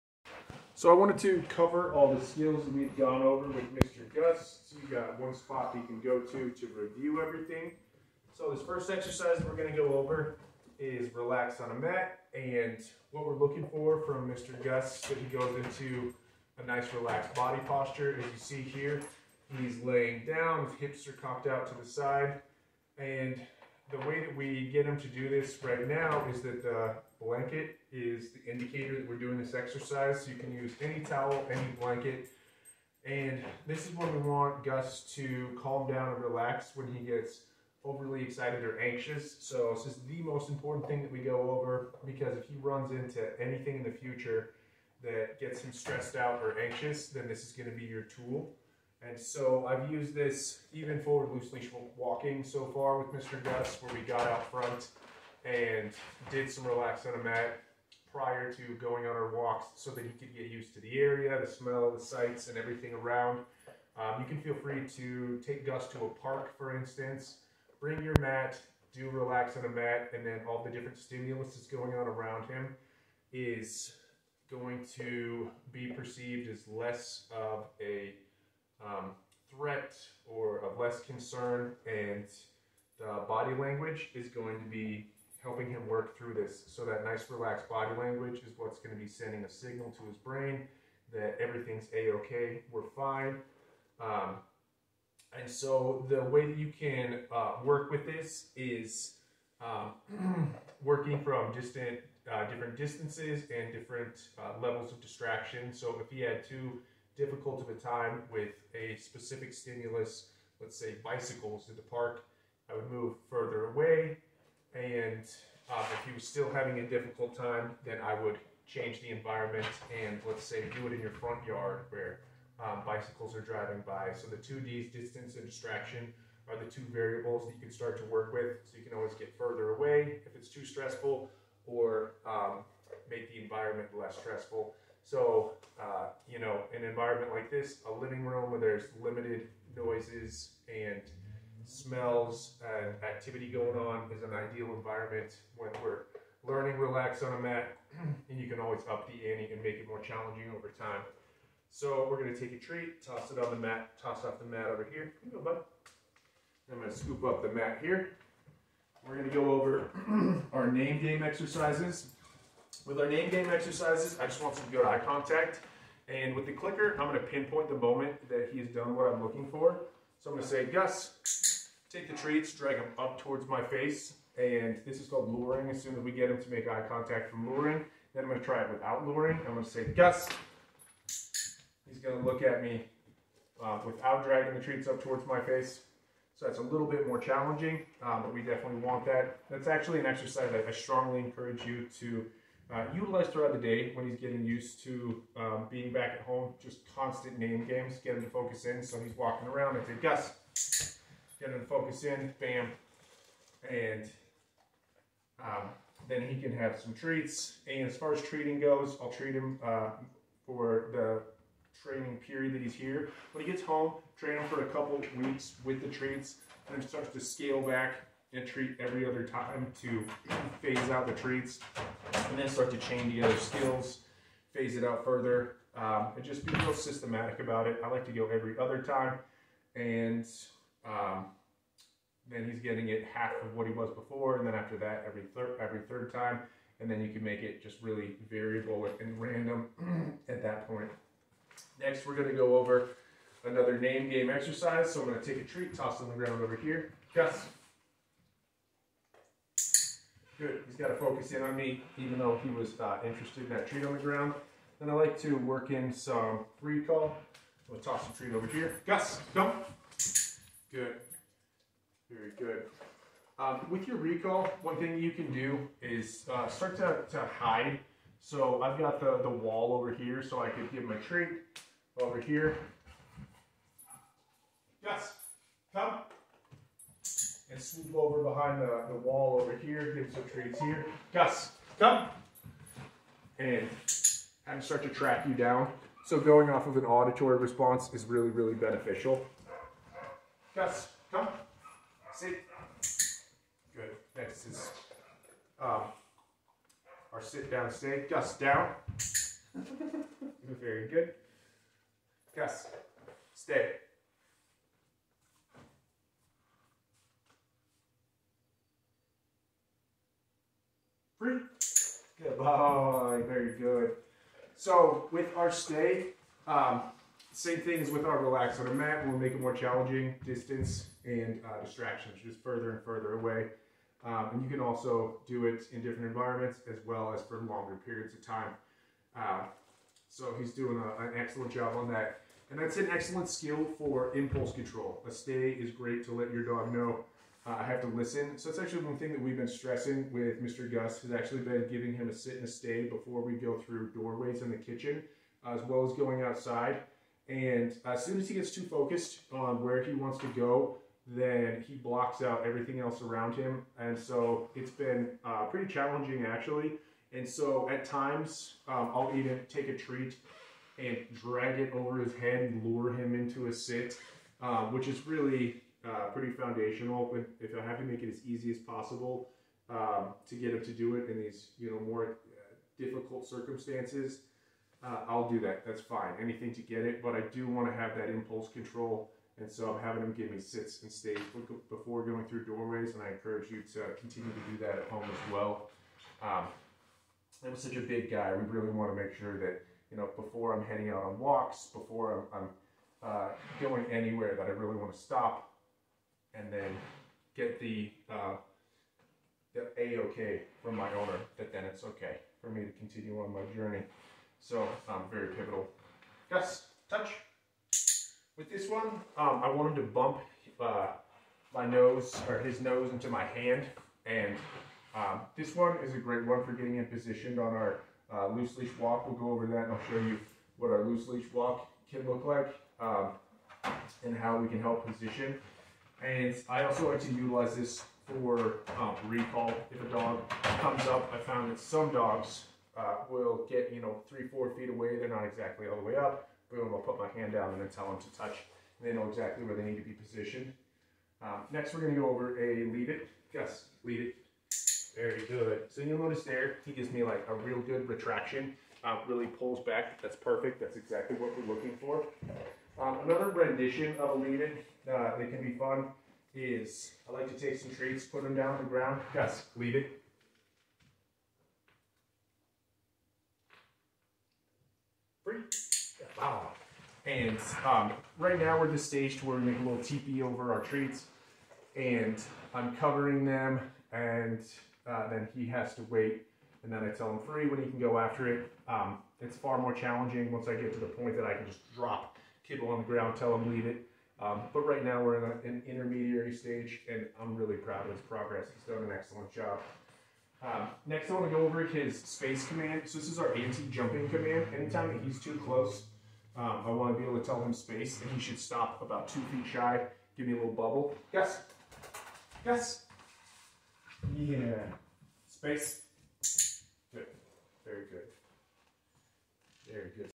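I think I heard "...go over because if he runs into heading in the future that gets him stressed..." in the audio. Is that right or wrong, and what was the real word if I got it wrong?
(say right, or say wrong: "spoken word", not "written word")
wrong: "anything", not "heading".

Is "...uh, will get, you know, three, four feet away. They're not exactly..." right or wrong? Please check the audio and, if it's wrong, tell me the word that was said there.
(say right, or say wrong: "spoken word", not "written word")
right.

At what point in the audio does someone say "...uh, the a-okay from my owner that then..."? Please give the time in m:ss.
6:38.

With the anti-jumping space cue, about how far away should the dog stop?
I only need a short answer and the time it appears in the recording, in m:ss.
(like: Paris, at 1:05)
2 feet, at 8:19.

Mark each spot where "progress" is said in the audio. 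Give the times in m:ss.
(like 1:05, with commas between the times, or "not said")
8:08.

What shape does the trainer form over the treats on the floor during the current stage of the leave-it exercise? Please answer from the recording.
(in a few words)
teepee.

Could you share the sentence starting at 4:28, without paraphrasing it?
So I've got the, the wall over here, so I could give him a treat over here.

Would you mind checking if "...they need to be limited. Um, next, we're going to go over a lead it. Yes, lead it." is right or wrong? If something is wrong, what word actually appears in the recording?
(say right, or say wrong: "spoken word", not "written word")
wrong: "positioned", not "limited".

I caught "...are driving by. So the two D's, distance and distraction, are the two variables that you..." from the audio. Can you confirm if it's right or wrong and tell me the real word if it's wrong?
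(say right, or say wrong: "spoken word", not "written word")
right.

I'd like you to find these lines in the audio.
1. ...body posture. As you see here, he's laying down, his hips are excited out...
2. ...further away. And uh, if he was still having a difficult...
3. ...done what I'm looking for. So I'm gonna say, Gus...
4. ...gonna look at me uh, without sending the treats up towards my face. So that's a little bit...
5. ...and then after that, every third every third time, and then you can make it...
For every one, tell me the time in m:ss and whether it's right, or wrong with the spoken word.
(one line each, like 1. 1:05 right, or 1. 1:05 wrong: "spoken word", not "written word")
1. 0:17 wrong: "cocked", not "excited"
2. 1:53 right
3. 2:48 right
4. 3:02 wrong: "dragging", not "sending"
5. 3:54 right.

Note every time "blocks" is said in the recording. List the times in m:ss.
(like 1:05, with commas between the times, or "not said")
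5:51.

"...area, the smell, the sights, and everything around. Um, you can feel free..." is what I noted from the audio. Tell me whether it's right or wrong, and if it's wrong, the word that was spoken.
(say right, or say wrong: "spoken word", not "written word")
right.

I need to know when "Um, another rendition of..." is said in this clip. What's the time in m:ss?
7:32.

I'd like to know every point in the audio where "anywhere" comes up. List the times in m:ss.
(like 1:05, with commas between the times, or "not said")
6:33.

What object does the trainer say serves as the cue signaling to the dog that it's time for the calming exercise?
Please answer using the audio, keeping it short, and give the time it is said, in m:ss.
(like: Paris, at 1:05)
the blanket, at 0:26.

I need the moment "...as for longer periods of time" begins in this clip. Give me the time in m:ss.
5:27.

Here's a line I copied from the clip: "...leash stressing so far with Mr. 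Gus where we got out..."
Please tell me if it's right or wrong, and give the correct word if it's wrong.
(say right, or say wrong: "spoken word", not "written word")
wrong: "walking", not "stressing".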